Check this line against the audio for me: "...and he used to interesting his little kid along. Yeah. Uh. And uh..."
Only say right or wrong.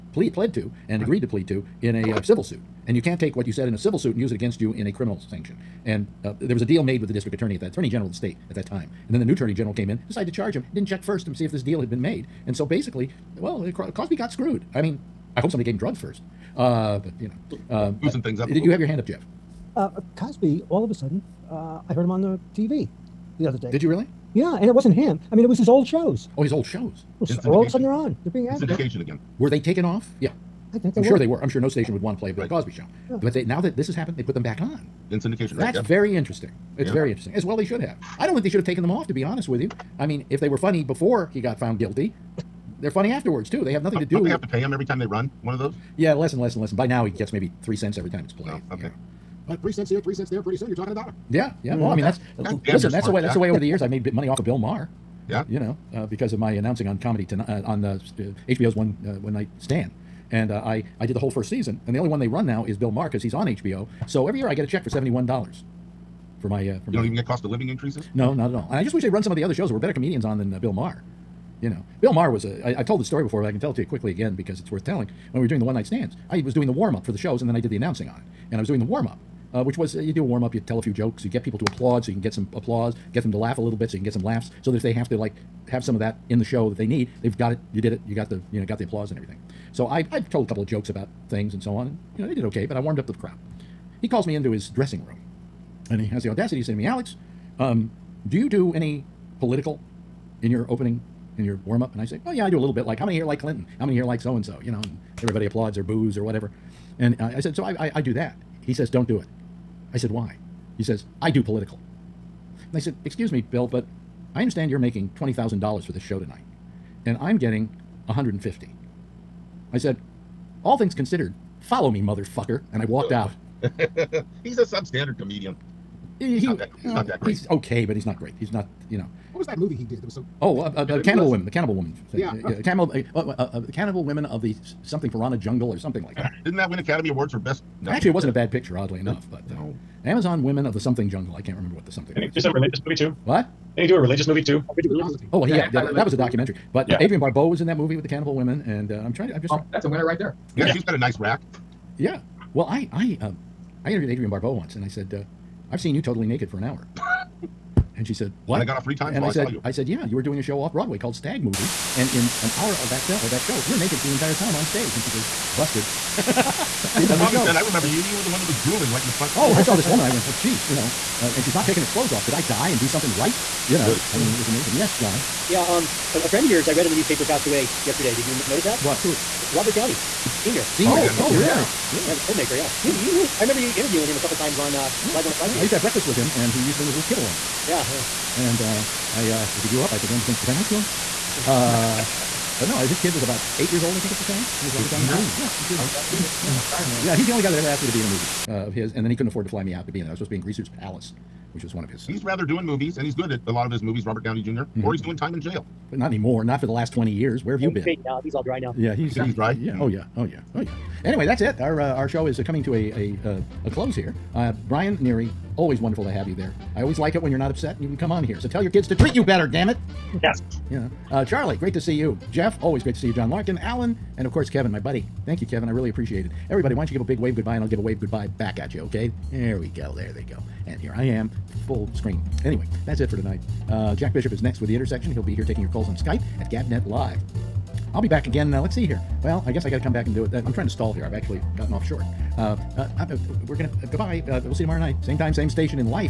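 wrong.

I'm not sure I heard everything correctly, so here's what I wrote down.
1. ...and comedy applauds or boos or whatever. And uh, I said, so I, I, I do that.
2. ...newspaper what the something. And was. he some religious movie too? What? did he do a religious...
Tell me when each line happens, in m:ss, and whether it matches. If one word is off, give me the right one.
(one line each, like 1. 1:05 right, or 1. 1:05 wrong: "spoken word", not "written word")
1. 1:44 wrong: "everybody", not "comedy"
2. 2:21 wrong: "remember", not "newspaper".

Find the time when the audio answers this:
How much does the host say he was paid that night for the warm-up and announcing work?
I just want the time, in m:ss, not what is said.
1:58.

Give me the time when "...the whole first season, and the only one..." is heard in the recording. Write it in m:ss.
1:01.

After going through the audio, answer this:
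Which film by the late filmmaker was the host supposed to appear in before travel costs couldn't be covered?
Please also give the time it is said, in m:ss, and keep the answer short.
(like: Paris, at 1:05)
Greaser's Palace, at 3:20.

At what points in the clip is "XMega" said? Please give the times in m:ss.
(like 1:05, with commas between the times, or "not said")
not said.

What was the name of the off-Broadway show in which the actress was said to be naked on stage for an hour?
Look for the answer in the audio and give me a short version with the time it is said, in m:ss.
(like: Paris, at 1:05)
Stag Movie, at 2:41.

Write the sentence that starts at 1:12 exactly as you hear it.
I, I've told the story before, but I can tell it to you quickly again because it's worth telling.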